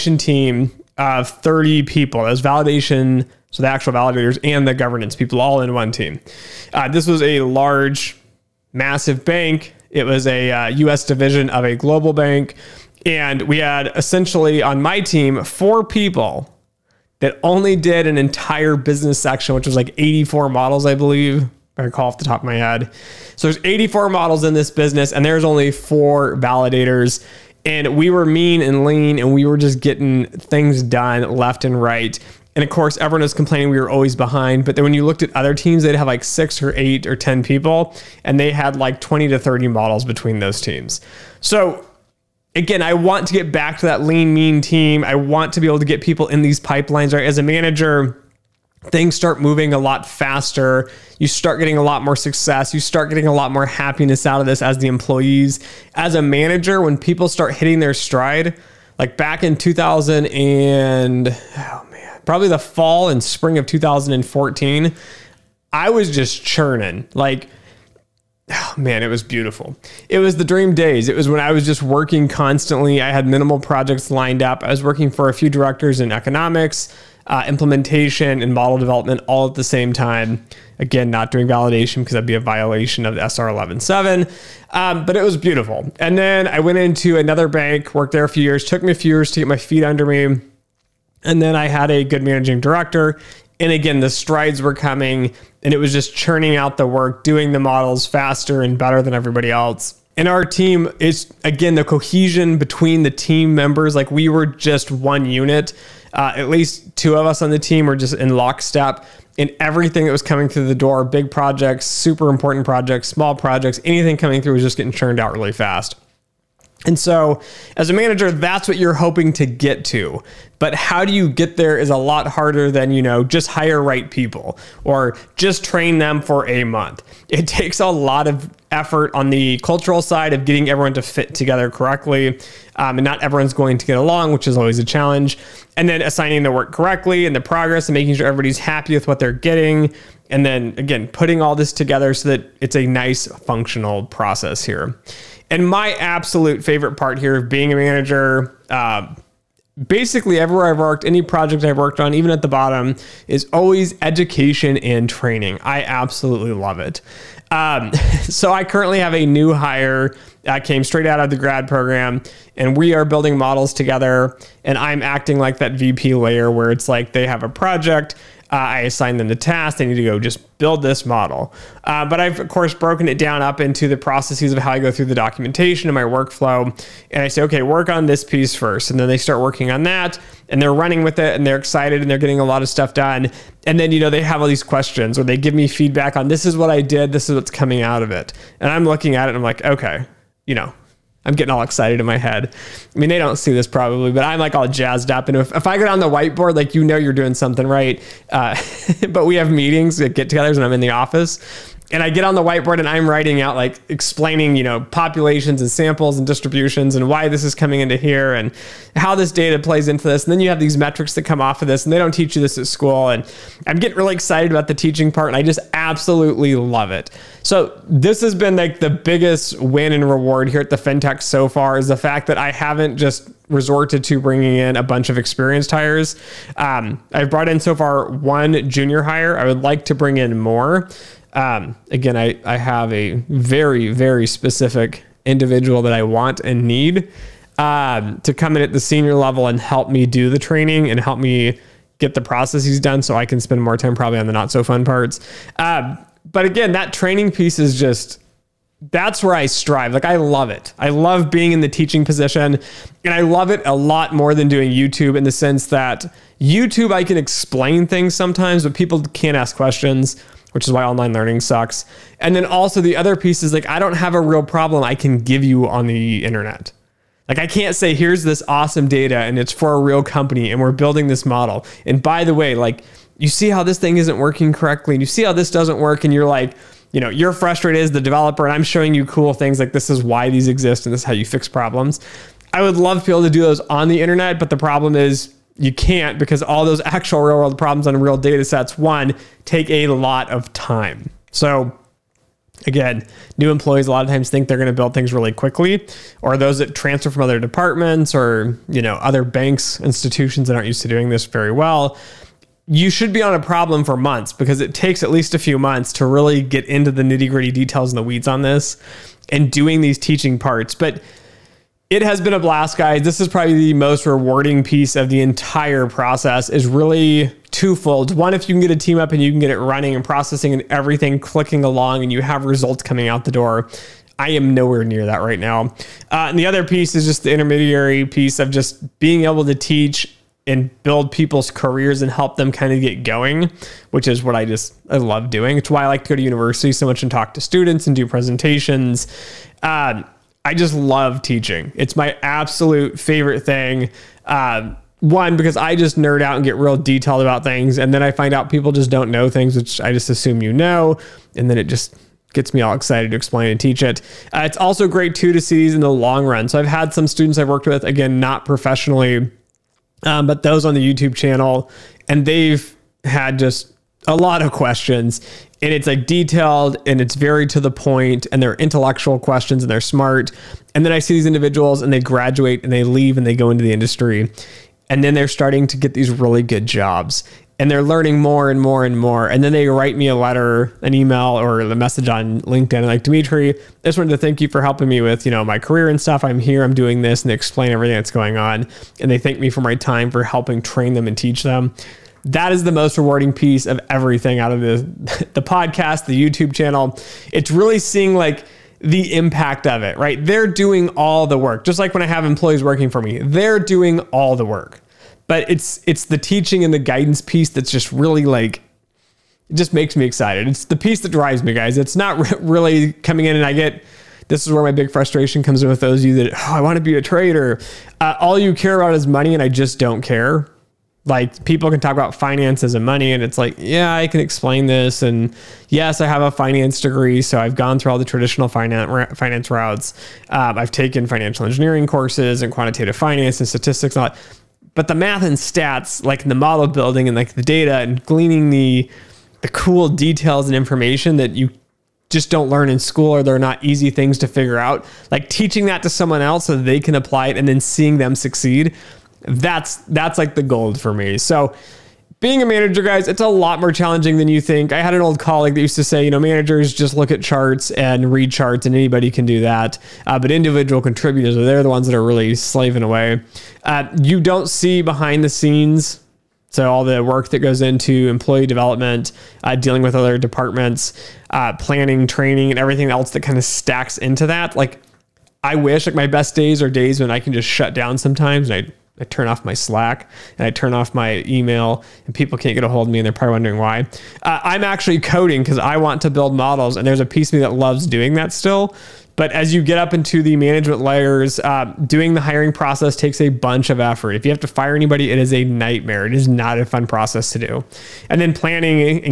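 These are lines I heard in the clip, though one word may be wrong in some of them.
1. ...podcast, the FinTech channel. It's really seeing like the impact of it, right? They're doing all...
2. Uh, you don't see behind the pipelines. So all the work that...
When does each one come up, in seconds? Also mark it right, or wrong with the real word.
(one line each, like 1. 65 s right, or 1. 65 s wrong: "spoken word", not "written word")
1. 395 s wrong: "YouTube", not "FinTech"
2. 463 s wrong: "scenes", not "pipelines".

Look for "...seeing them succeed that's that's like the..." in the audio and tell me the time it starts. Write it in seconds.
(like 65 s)
447 s.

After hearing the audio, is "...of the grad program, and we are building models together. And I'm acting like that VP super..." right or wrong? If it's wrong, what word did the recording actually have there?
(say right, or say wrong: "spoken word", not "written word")
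wrong: "layer", not "super".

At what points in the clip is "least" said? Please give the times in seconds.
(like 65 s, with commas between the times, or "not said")
106 s, 305 s.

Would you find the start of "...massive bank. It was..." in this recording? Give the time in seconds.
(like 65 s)
8 s.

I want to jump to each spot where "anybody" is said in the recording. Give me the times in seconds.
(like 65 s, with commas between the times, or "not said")
458 s, 494 s.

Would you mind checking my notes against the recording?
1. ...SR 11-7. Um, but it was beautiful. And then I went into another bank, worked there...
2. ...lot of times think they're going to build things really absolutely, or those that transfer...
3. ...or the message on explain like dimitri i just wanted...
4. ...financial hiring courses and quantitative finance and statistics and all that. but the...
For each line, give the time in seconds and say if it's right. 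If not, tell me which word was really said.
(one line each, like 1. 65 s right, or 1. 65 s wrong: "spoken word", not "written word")
1. 83 s right
2. 293 s wrong: "quickly", not "absolutely"
3. 381 s wrong: "linkedin", not "explain"
4. 431 s wrong: "engineering", not "hiring".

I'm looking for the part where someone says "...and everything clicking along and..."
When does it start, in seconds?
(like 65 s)
320 s.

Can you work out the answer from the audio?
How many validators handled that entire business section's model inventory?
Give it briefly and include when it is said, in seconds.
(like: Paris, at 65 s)
4, at 25 s.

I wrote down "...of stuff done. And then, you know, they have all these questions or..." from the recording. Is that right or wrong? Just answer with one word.
right.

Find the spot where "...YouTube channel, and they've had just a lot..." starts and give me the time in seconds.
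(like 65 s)
360 s.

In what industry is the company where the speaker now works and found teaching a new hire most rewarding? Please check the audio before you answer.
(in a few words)
FinTech.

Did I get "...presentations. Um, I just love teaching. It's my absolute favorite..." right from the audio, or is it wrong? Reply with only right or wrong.
right.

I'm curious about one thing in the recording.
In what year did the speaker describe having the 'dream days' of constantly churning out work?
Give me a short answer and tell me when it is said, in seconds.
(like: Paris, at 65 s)
2014, at 63 s.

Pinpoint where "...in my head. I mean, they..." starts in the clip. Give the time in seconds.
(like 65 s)
191 s.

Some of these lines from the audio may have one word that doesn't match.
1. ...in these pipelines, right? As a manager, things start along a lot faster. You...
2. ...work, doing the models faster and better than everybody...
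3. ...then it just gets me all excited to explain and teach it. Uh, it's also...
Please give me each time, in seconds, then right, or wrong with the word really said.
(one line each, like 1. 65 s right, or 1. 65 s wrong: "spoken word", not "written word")
1. 46 s wrong: "moving", not "along"
2. 96 s right
3. 351 s right.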